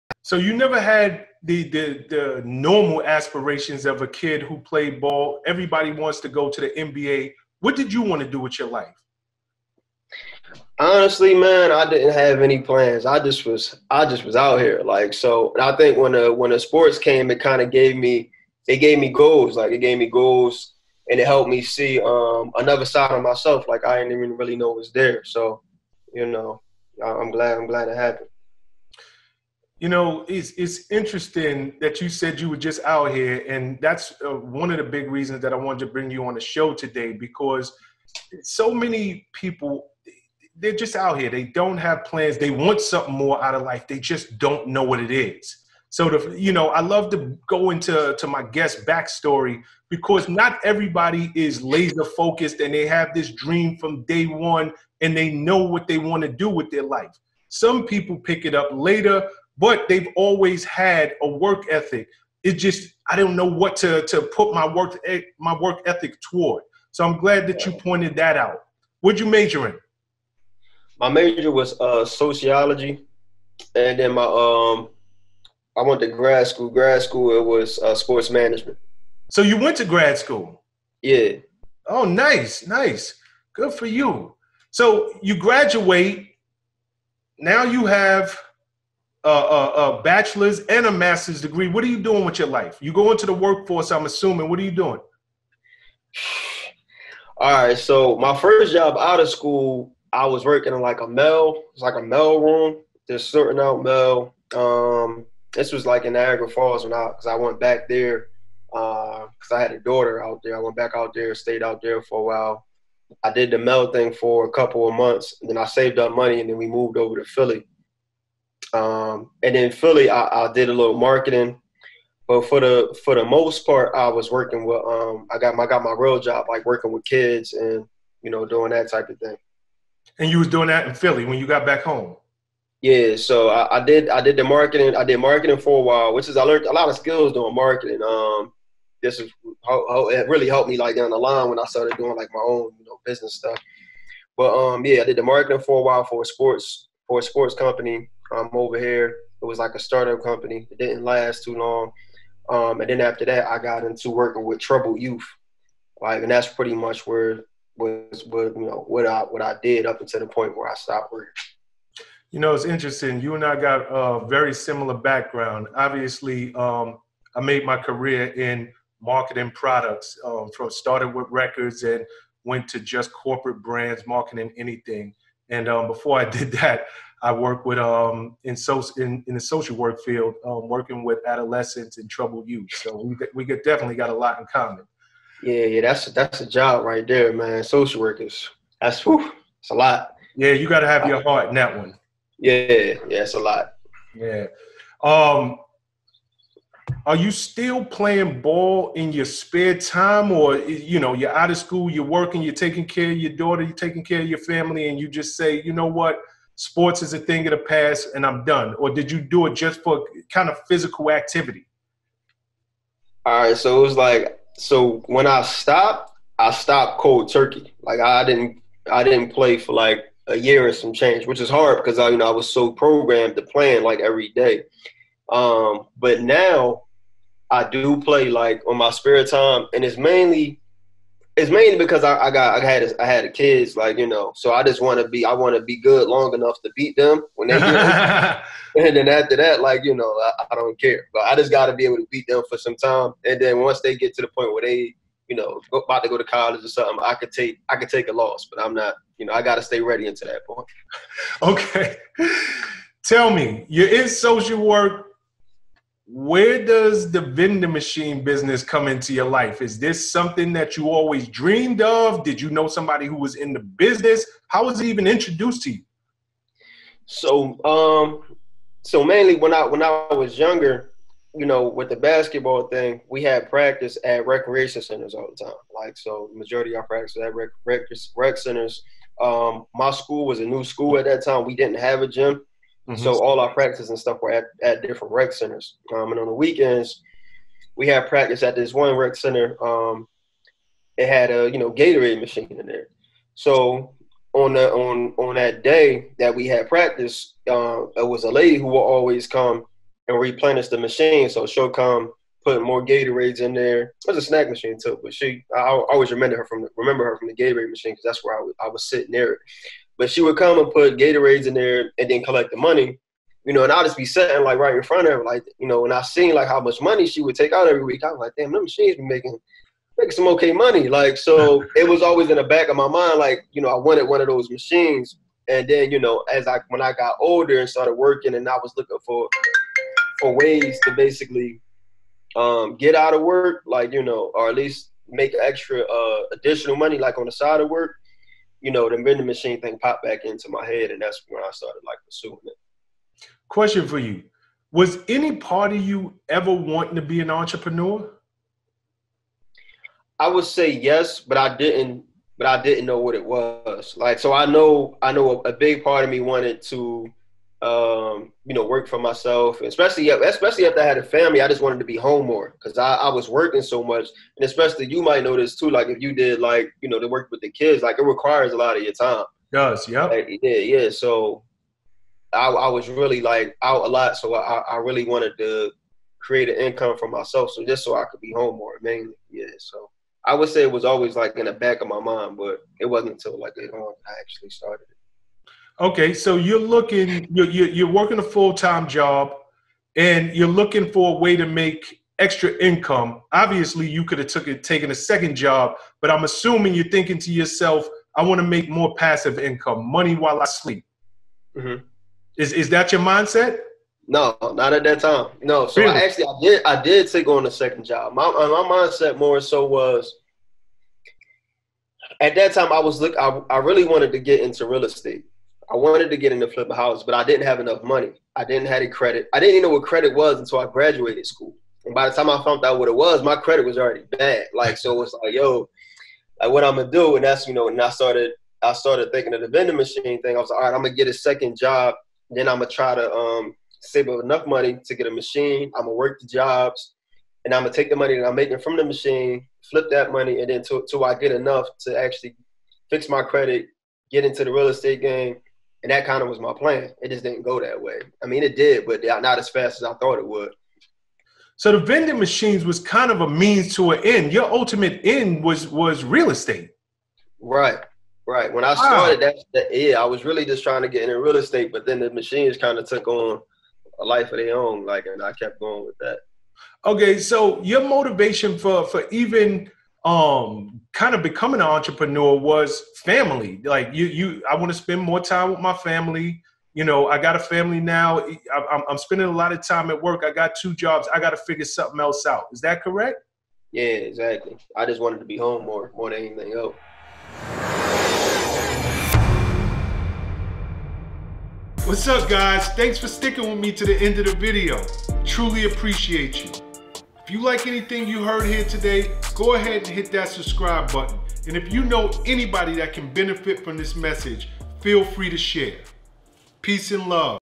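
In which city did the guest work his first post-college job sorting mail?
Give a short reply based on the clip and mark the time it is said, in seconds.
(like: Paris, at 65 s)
Niagara Falls, at 106 s.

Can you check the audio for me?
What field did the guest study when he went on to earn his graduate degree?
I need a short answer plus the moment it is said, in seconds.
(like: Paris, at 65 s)
Sports management, at 77 s.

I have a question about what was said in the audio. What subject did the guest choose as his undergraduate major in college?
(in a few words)
Sociology.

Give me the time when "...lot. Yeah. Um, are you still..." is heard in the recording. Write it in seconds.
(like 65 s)
193 s.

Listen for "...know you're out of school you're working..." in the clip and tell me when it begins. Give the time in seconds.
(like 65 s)
200 s.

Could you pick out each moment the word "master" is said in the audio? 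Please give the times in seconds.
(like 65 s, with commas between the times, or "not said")
90 s.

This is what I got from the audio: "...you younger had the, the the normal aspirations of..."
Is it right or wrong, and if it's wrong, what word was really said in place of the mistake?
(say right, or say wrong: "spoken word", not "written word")
wrong: "never", not "younger".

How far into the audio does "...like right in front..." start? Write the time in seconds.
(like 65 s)
314 s.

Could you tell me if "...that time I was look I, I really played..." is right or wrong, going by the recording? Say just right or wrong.
wrong.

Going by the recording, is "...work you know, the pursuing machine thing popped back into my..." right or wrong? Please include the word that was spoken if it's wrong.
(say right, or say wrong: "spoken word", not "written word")
wrong: "vending", not "pursuing".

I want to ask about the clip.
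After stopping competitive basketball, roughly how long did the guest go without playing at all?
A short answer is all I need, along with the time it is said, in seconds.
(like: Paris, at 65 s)
a year, at 220 s.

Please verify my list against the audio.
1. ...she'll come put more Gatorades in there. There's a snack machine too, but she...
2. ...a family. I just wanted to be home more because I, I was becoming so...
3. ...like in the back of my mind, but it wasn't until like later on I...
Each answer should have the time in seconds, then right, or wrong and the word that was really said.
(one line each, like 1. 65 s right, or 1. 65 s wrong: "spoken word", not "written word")
1. 301 s right
2. 360 s wrong: "working", not "becoming"
3. 381 s right.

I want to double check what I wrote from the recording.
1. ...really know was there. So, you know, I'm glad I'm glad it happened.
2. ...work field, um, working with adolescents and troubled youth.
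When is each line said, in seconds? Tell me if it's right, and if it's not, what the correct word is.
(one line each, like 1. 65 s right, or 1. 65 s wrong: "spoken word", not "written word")
1. 24 s right
2. 179 s right.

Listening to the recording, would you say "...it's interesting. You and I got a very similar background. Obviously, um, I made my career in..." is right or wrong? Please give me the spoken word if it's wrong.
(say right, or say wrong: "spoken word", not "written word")
right.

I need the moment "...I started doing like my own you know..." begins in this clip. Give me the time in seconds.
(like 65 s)
141 s.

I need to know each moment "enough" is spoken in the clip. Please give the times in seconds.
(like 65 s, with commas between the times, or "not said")
236 s, 417 s, 434 s, 441 s.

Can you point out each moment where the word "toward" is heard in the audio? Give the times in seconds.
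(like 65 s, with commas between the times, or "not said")
66 s.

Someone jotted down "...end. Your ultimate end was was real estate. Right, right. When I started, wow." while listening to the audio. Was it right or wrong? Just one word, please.
right.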